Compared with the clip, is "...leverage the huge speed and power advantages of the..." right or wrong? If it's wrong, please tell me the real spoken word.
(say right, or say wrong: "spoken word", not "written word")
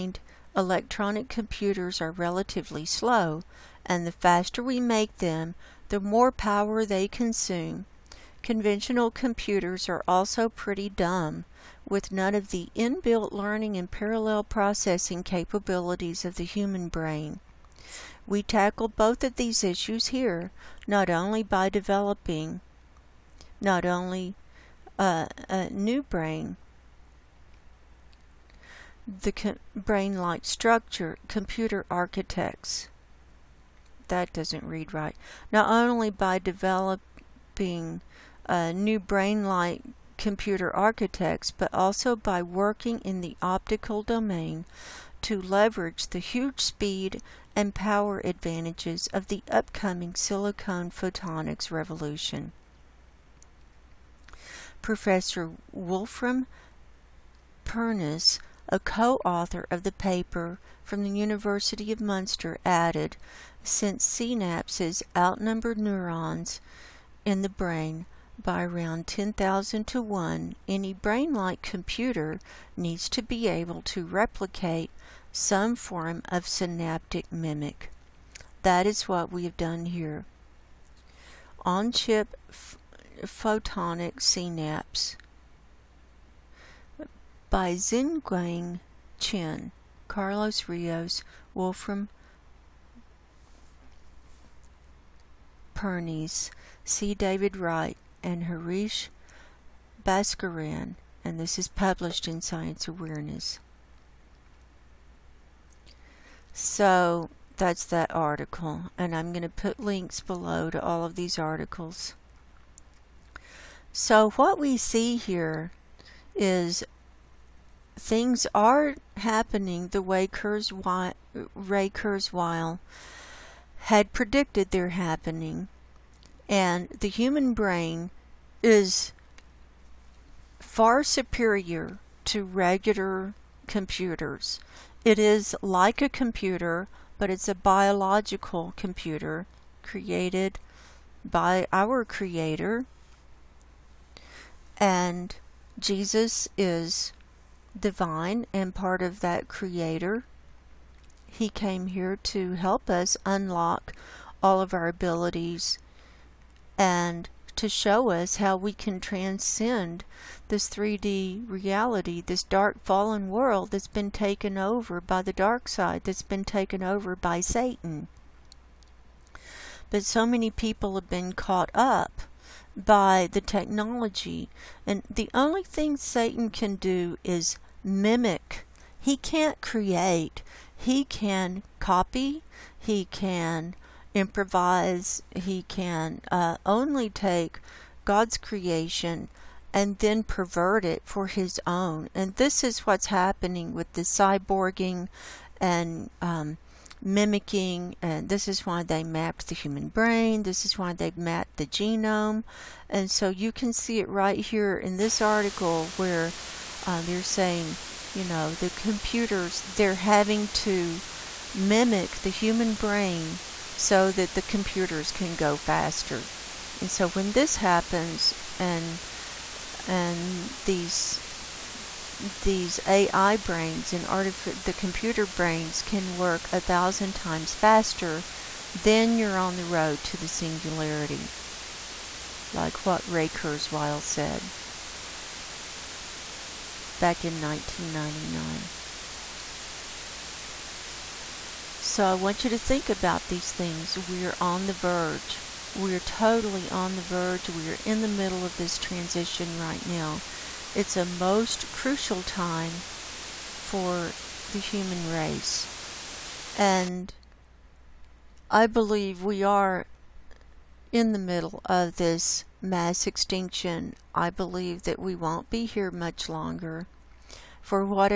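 right.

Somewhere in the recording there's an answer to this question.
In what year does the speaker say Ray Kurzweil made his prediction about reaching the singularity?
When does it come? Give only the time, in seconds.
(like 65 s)
237 s.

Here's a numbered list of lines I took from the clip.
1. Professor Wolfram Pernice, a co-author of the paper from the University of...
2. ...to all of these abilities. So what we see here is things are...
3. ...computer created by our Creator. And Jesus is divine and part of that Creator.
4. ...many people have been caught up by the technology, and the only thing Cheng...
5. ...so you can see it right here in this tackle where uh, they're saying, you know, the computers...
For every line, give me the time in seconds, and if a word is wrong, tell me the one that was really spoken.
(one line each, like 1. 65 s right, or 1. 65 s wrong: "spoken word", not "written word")
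1. 54 s right
2. 110 s wrong: "articles", not "abilities"
3. 138 s right
4. 170 s wrong: "Satan", not "Cheng"
5. 203 s wrong: "article", not "tackle".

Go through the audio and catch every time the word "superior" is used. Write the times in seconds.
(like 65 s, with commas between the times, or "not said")
131 s.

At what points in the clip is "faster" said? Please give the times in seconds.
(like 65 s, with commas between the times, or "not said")
4 s, 215 s, 227 s.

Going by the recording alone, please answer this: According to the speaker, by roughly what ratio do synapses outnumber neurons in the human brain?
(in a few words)
10,000 to 1.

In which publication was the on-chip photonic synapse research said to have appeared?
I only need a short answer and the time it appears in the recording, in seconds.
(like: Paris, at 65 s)
Science Awareness, at 102 s.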